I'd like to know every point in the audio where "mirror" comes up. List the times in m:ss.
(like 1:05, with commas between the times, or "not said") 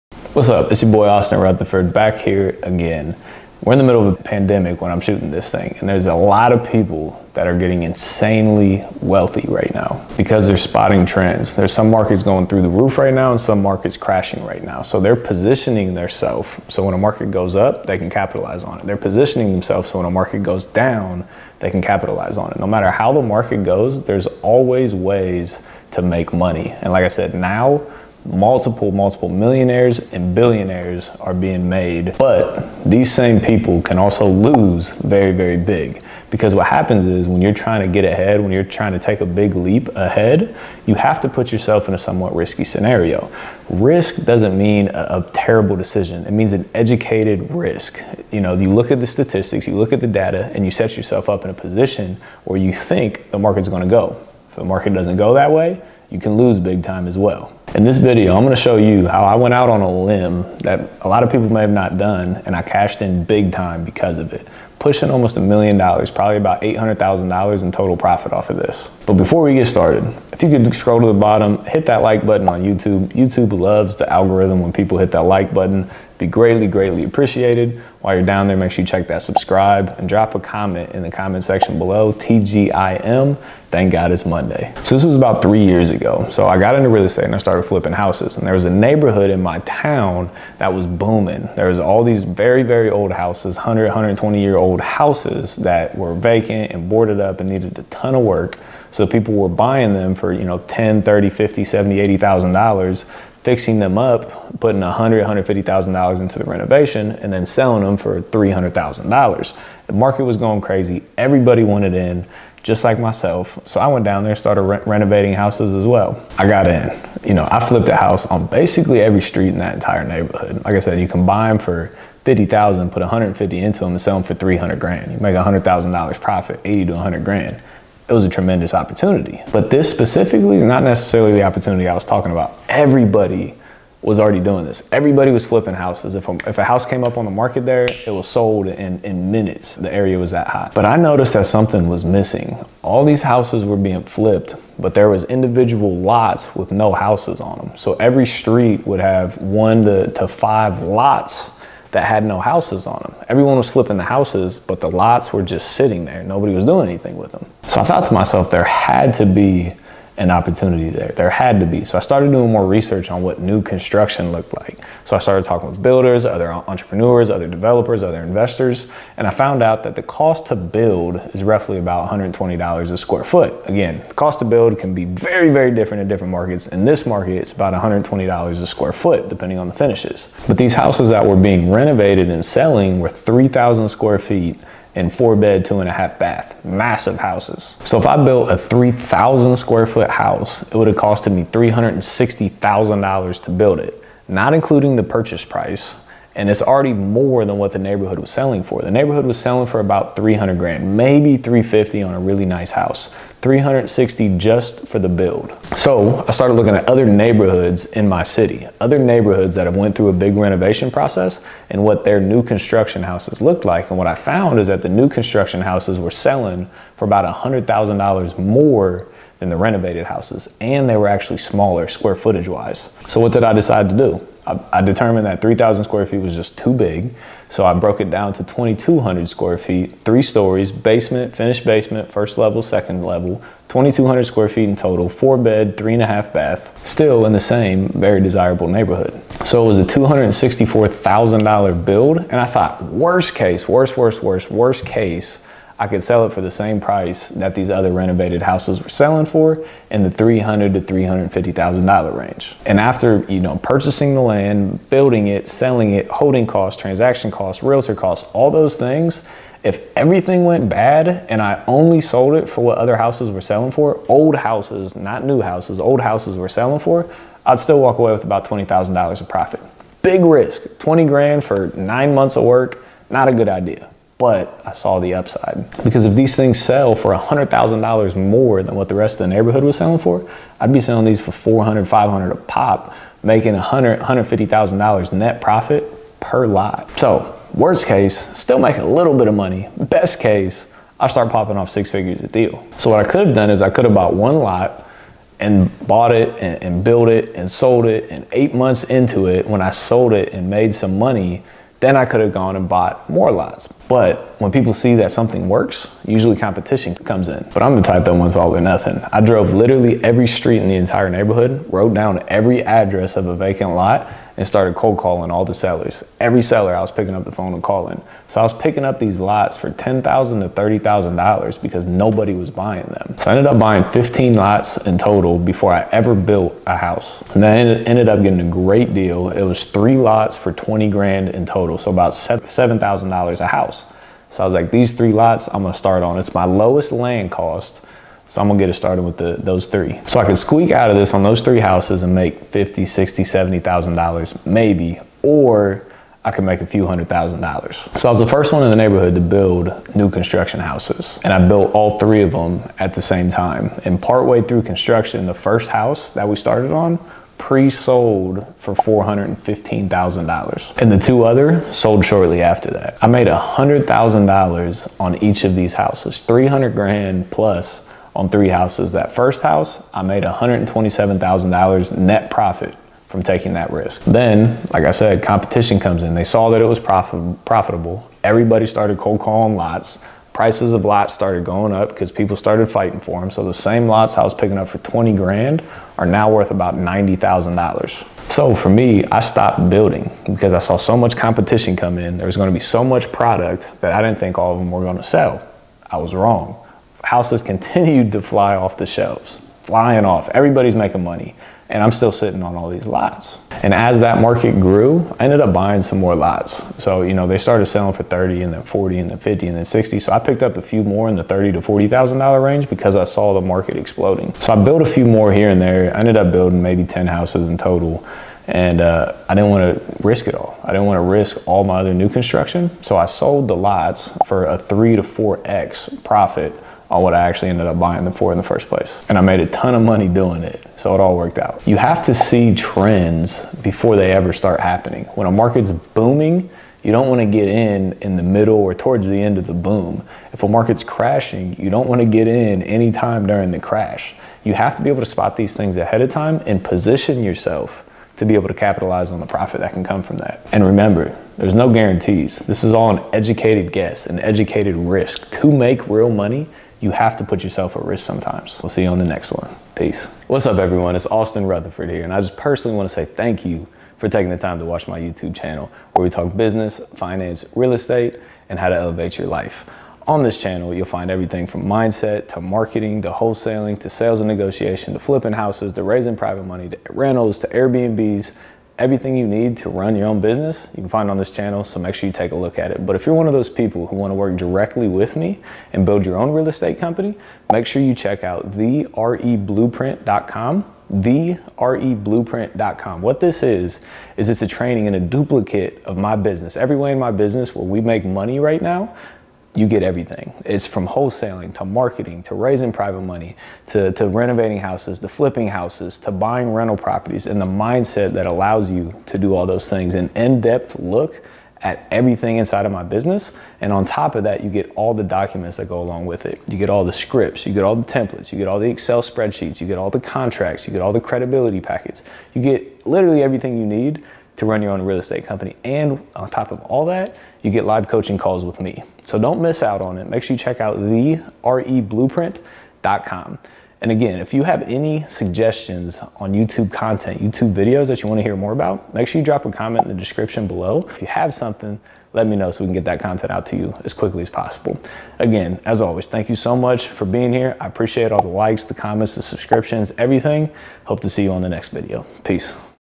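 not said.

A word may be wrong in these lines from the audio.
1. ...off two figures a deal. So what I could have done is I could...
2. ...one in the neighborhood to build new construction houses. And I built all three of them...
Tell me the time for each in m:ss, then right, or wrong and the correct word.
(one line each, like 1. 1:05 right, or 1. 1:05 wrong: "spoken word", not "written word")
1. 4:51 wrong: "six", not "two"
2. 5:48 right.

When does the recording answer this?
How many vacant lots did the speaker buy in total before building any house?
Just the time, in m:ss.
5:23.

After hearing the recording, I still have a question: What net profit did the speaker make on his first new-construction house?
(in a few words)
$127,000.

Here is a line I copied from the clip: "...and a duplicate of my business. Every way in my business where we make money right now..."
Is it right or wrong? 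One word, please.
right.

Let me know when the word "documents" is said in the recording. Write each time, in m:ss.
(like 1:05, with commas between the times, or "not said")
8:35.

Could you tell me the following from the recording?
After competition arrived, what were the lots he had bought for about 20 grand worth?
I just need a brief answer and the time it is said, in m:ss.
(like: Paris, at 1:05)
$90,000, at 6:26.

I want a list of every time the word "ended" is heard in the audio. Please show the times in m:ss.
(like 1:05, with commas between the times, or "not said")
5:23, 5:27, 6:45, 6:55, 7:07.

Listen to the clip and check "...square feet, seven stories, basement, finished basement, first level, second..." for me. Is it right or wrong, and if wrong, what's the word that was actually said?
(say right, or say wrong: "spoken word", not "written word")
wrong: "three", not "seven".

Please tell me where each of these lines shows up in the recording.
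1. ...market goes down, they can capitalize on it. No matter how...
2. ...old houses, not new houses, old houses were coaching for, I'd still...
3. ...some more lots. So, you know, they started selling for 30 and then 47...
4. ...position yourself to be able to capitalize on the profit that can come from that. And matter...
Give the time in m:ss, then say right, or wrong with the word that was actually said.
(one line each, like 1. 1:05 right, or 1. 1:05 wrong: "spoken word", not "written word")
1. 0:20 right
2. 4:24 wrong: "selling", not "coaching"
3. 6:45 wrong: "40", not "47"
4. 7:26 wrong: "remember", not "matter".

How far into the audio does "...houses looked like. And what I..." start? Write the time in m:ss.
3:33.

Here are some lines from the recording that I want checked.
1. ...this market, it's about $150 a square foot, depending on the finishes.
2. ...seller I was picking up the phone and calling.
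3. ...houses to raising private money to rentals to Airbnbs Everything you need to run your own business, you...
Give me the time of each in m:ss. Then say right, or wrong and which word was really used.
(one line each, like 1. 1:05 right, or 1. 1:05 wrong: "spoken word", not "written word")
1. 2:56 wrong: "120", not "150"
2. 5:16 right
3. 7:55 right.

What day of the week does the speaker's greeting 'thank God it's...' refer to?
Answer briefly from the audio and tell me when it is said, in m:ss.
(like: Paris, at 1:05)
Monday, at 1:24.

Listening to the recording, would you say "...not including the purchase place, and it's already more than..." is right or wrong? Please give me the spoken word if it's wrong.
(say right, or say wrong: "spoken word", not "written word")
wrong: "price", not "place".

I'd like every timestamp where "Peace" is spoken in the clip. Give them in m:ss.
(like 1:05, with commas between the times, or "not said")
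7:39, 9:12.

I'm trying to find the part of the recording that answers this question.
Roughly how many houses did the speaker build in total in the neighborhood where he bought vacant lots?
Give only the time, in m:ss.
6:56.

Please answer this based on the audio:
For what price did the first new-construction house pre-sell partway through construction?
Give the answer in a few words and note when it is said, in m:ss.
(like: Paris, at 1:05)
$415,000, at 5:58.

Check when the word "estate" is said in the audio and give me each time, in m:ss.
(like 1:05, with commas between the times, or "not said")
1:27, 7:47, 8:06, 8:44.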